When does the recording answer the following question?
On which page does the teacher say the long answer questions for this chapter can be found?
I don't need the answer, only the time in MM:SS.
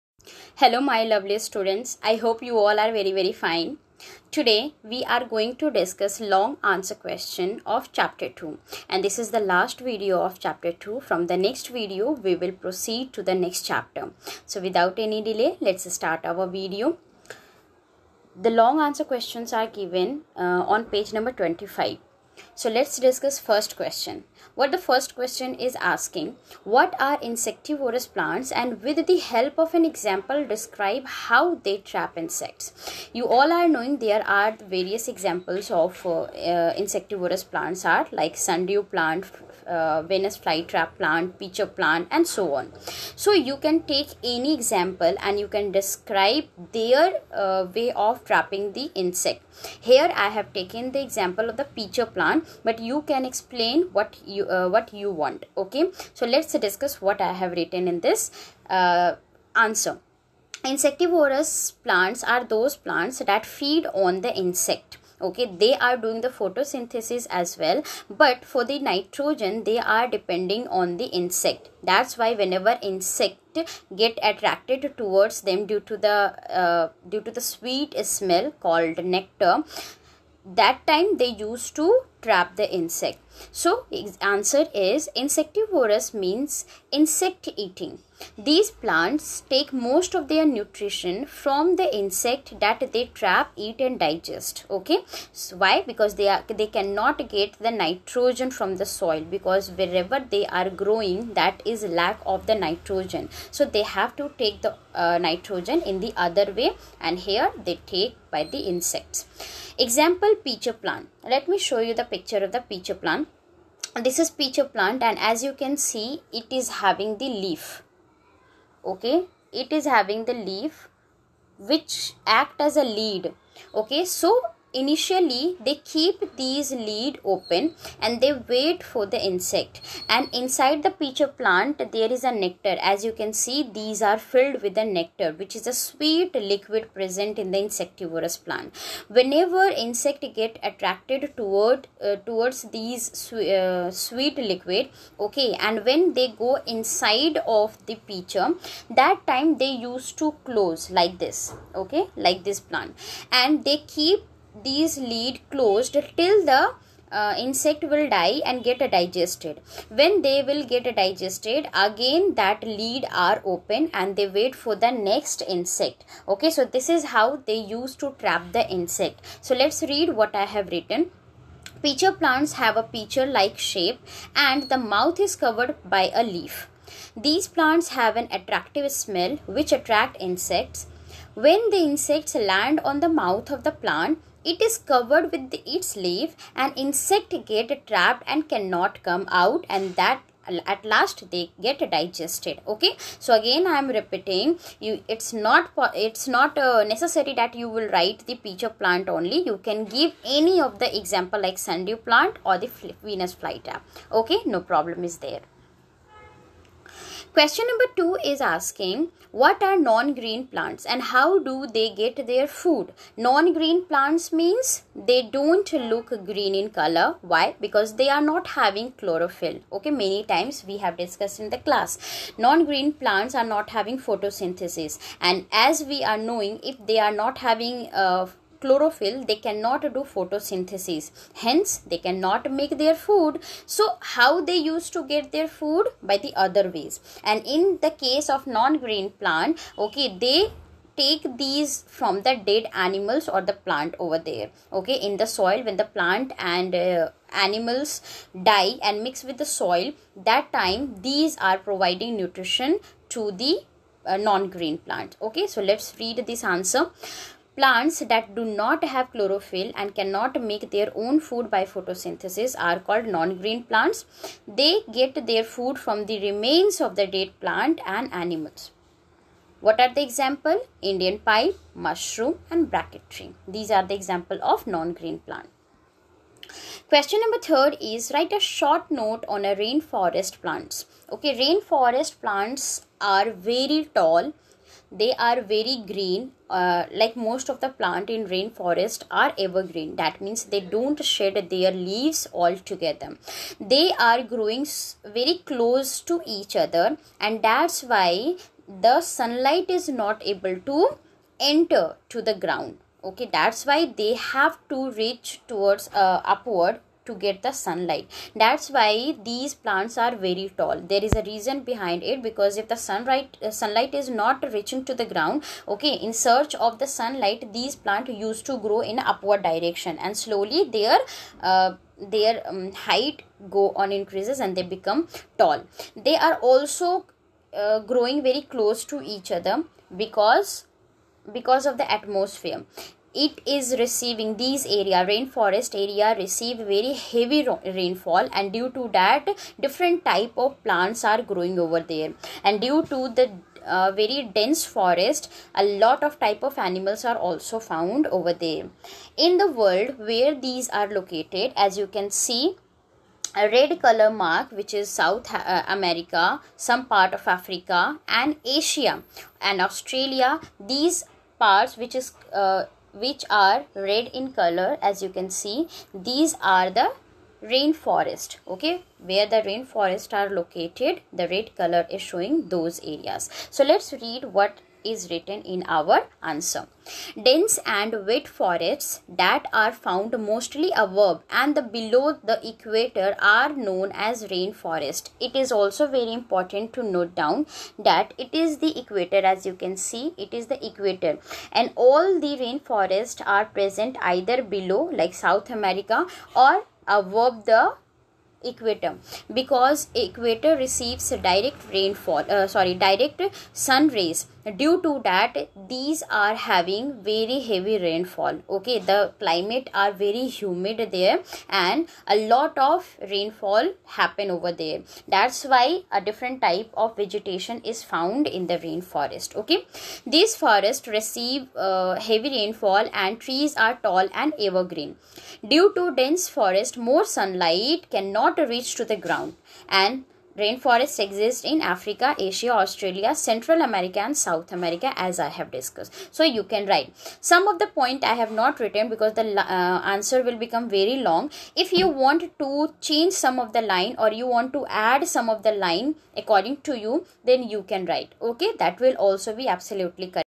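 00:20.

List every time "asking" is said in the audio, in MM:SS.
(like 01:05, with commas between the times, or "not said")
00:25, 03:28.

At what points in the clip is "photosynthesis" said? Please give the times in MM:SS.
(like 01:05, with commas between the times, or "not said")
01:06, 03:43, 03:50, 04:21.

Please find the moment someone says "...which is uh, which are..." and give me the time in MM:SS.
06:01.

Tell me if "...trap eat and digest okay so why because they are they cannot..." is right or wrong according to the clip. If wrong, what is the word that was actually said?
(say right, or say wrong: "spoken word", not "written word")
right.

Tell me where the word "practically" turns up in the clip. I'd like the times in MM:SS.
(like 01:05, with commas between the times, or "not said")
not said.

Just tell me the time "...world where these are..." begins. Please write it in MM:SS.
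05:49.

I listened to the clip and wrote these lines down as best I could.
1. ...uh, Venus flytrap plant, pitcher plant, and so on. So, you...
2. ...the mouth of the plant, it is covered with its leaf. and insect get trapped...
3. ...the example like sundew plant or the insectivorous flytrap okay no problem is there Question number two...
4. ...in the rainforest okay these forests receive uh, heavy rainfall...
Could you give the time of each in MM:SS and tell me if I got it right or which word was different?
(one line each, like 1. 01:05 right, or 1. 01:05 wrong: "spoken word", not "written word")
1. 00:39 right
2. 03:02 right
3. 03:20 wrong: "venus", not "insectivorous"
4. 06:58 right.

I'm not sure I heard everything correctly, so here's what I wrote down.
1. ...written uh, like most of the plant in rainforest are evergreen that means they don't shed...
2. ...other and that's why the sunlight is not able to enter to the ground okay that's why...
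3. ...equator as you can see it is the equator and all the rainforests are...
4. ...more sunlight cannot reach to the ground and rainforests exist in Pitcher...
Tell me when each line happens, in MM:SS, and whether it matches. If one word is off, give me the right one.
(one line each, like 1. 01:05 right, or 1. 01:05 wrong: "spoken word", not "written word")
1. 04:45 wrong: "green", not "written"
2. 04:56 right
3. 06:28 right
4. 07:06 wrong: "Africa", not "Pitcher".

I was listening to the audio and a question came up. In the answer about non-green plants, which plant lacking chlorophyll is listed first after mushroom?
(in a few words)
Indian pipe.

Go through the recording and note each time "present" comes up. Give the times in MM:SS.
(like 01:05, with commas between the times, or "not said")
02:16, 06:33.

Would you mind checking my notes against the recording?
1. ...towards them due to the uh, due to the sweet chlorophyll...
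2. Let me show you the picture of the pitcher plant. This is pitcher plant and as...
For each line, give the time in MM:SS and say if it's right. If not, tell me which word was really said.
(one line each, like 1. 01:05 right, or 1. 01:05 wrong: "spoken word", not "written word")
1. 01:14 wrong: "smell", not "chlorophyll"
2. 01:51 right.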